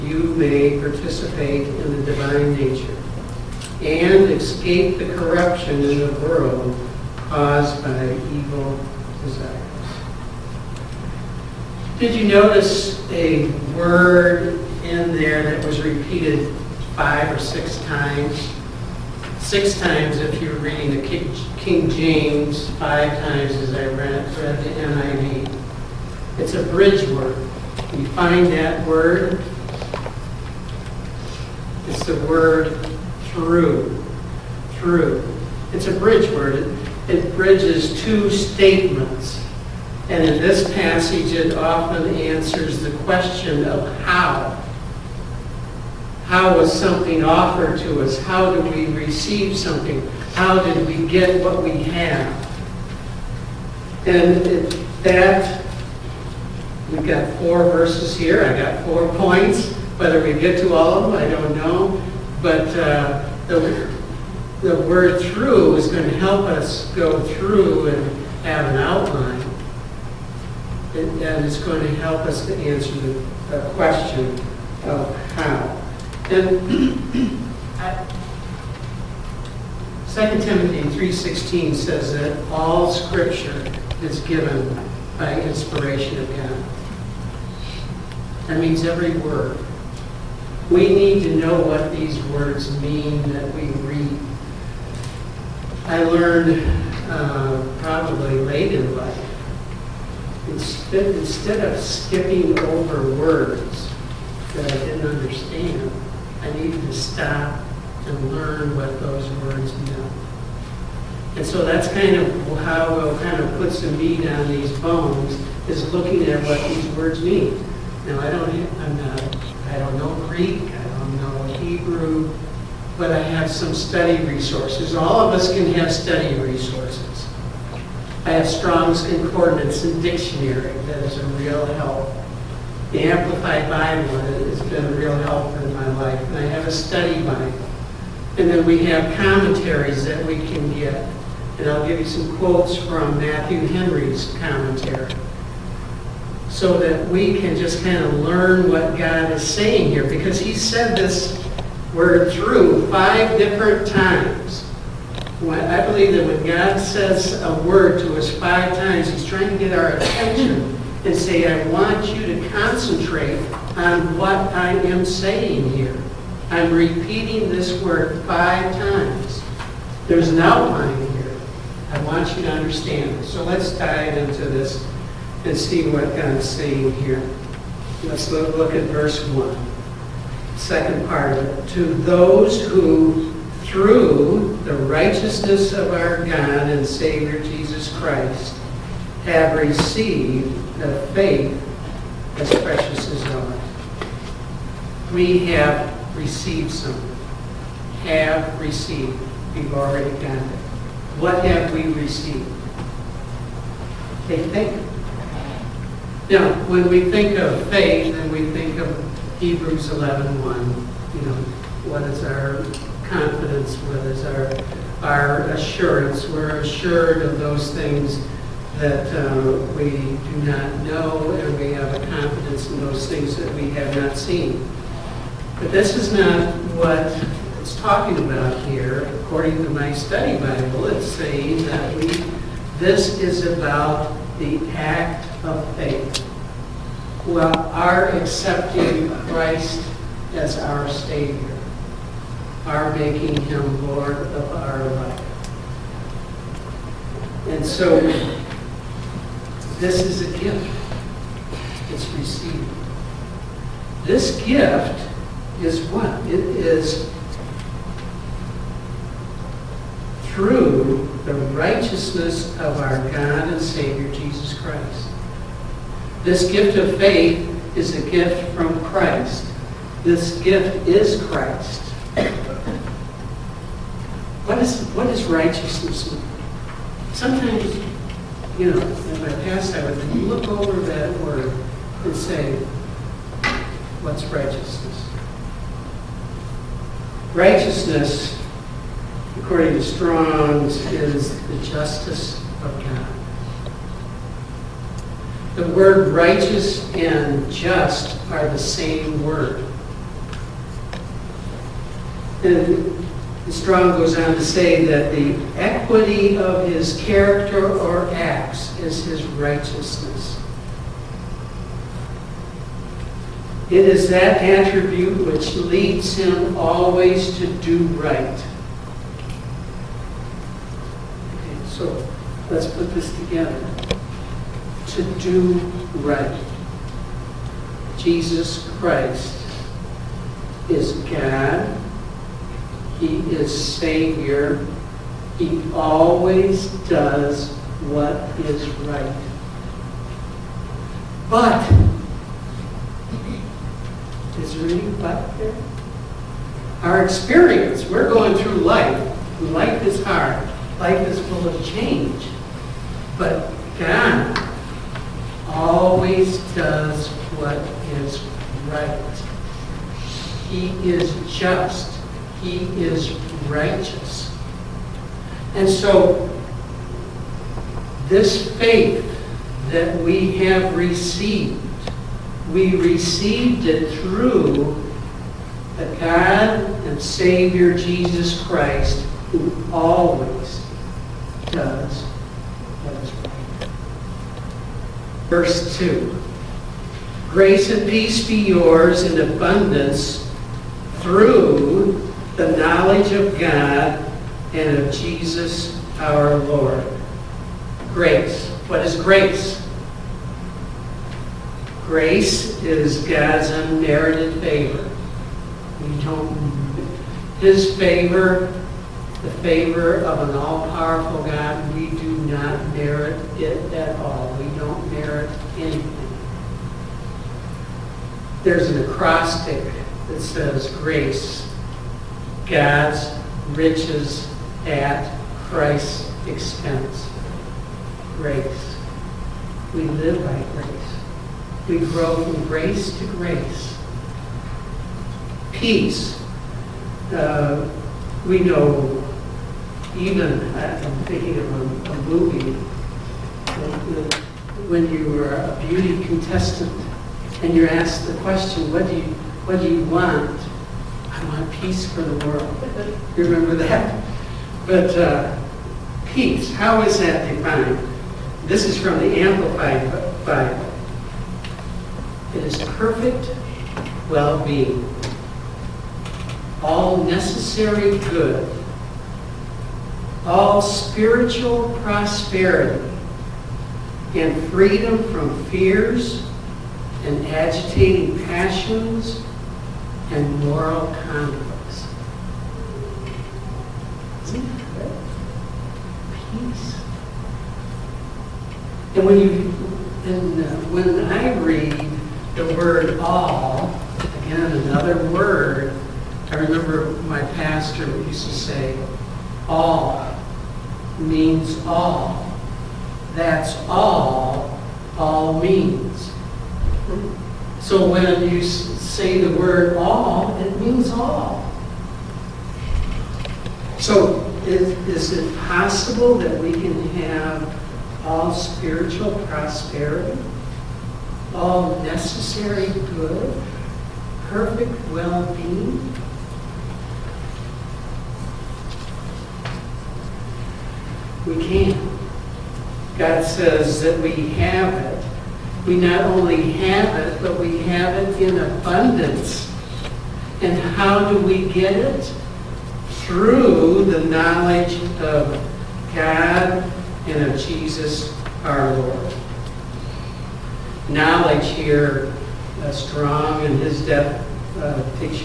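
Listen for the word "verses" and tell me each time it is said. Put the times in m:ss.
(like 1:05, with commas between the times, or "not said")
0:57, 2:58, 6:25.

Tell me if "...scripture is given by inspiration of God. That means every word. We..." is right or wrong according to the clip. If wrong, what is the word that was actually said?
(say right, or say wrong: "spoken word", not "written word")
right.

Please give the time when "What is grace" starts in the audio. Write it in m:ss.
6:38.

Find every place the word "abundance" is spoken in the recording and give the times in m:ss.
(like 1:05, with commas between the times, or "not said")
6:29, 8:58.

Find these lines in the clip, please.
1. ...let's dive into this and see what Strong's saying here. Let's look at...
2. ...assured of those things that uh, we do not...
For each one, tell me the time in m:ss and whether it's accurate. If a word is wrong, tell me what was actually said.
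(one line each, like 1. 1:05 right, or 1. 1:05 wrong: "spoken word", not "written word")
1. 2:53 wrong: "God", not "Strong"
2. 3:36 right.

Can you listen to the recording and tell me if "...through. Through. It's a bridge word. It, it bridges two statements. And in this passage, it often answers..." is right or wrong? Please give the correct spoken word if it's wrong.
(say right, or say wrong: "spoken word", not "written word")
right.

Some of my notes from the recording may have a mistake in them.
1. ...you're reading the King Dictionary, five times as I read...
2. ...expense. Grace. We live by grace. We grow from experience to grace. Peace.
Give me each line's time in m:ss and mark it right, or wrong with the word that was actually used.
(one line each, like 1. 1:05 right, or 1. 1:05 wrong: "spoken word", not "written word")
1. 0:20 wrong: "James", not "Dictionary"
2. 7:06 wrong: "grace", not "experience".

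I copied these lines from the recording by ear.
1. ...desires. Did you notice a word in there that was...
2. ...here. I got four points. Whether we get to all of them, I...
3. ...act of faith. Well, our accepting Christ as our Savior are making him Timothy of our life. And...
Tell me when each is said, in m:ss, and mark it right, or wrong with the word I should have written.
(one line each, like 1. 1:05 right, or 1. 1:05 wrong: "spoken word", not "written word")
1. 0:09 right
2. 0:58 right
3. 3:54 wrong: "Lord", not "Timothy".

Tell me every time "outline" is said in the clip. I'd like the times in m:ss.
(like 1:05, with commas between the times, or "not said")
1:08, 2:50.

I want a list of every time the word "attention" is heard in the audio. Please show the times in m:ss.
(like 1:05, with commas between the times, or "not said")
2:39.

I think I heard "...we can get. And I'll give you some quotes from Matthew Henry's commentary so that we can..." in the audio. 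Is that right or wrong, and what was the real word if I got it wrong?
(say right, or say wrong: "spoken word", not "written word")
right.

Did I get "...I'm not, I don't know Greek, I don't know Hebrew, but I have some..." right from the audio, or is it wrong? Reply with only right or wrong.
right.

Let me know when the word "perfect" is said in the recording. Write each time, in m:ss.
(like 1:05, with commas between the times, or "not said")
7:42, 8:44.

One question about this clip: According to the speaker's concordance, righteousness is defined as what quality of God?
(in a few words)
the justice of God.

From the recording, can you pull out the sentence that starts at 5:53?
But God always does what is right.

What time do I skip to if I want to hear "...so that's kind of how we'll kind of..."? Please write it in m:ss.
1:51.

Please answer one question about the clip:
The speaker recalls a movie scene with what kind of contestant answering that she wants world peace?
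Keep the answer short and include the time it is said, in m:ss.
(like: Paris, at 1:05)
beauty contestant, at 7:25.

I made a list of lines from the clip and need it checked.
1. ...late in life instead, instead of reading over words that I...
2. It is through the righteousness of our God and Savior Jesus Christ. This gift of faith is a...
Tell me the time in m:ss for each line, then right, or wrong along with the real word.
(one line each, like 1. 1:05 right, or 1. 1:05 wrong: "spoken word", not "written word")
1. 1:38 wrong: "skipping", not "reading"
2. 4:16 right.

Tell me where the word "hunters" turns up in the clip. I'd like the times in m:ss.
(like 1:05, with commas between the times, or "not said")
not said.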